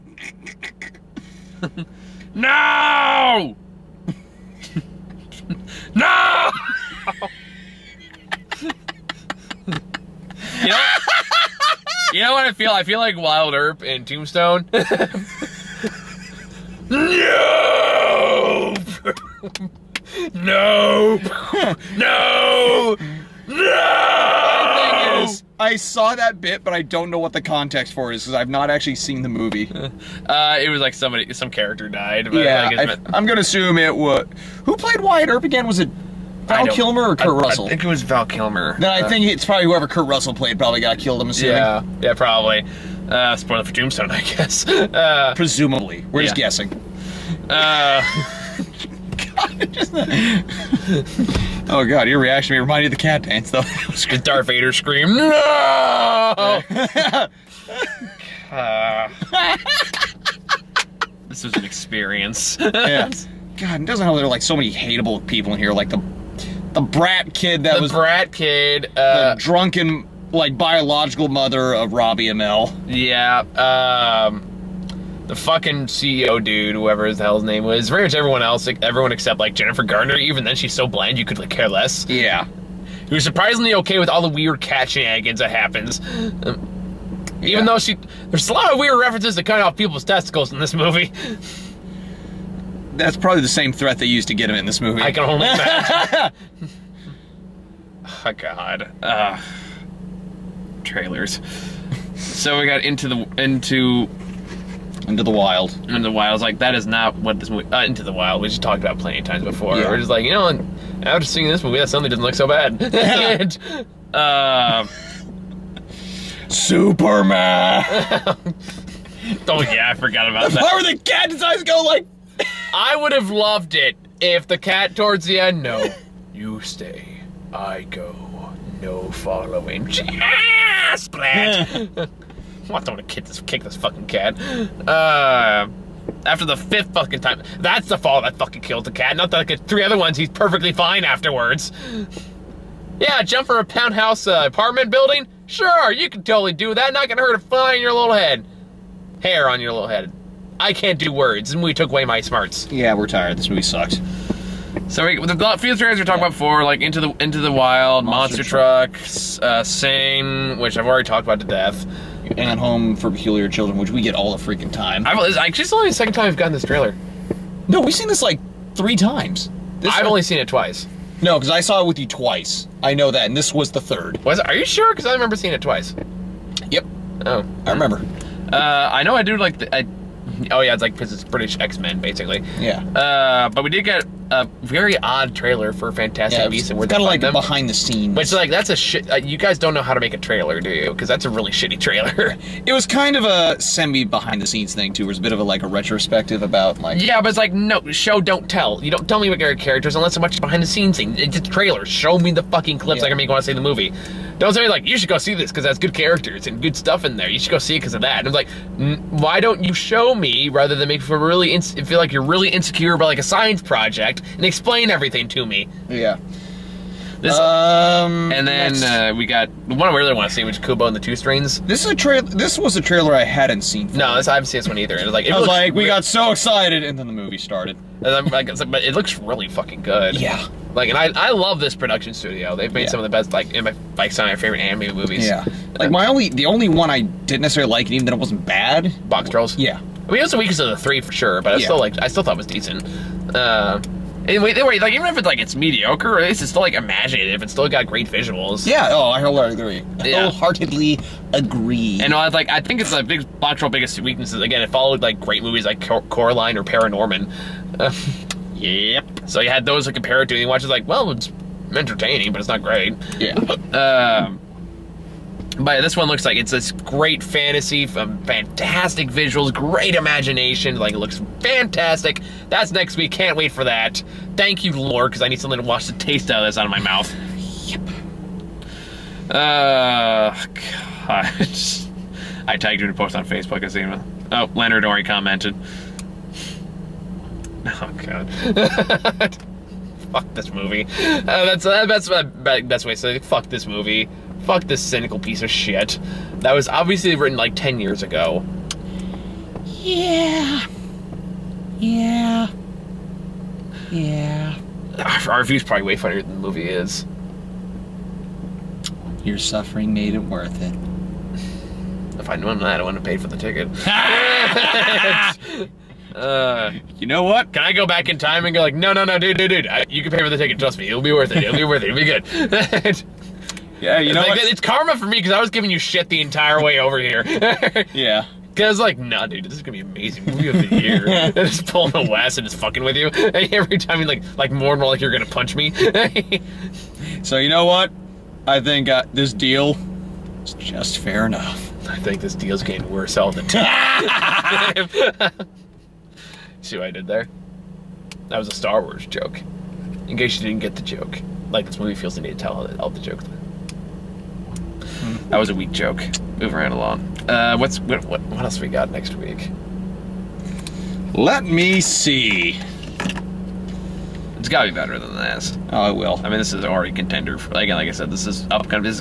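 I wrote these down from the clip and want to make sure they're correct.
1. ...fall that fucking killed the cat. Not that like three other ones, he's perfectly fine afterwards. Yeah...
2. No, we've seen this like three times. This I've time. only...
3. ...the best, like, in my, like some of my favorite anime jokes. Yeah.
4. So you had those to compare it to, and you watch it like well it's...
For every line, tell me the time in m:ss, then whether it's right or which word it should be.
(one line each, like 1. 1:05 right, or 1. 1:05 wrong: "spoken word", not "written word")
1. 2:17 right
2. 2:47 right
3. 3:53 wrong: "movies", not "jokes"
4. 4:19 right.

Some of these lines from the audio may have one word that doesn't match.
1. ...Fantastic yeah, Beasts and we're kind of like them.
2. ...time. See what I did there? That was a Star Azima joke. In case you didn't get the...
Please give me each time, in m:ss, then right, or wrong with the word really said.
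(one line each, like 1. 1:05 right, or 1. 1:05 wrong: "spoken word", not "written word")
1. 3:05 right
2. 5:43 wrong: "Wars", not "Azima".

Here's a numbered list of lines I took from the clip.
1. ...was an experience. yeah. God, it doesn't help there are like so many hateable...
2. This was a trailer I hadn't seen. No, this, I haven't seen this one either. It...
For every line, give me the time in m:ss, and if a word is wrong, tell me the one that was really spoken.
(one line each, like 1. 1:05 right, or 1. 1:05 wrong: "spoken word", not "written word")
1. 1:01 right
2. 3:42 right.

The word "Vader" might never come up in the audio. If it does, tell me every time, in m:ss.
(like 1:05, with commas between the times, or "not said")
0:54.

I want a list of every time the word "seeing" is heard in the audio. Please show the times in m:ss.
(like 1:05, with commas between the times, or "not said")
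1:51, 2:55.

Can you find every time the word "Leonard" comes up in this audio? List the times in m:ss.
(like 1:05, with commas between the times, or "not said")
4:44.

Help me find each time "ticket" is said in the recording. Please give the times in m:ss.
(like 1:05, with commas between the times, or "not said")
5:13, 5:20.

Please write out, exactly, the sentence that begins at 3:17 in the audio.
Yeah, but it's like no show, don't tell.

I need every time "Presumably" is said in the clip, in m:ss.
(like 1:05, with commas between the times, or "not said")
0:45.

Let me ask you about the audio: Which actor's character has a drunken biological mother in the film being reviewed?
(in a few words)
Robbie Amell.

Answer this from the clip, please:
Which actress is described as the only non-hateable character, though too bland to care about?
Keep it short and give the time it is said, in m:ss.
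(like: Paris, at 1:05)
Jennifer Garner, at 1:19.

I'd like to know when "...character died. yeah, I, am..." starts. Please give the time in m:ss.
0:31.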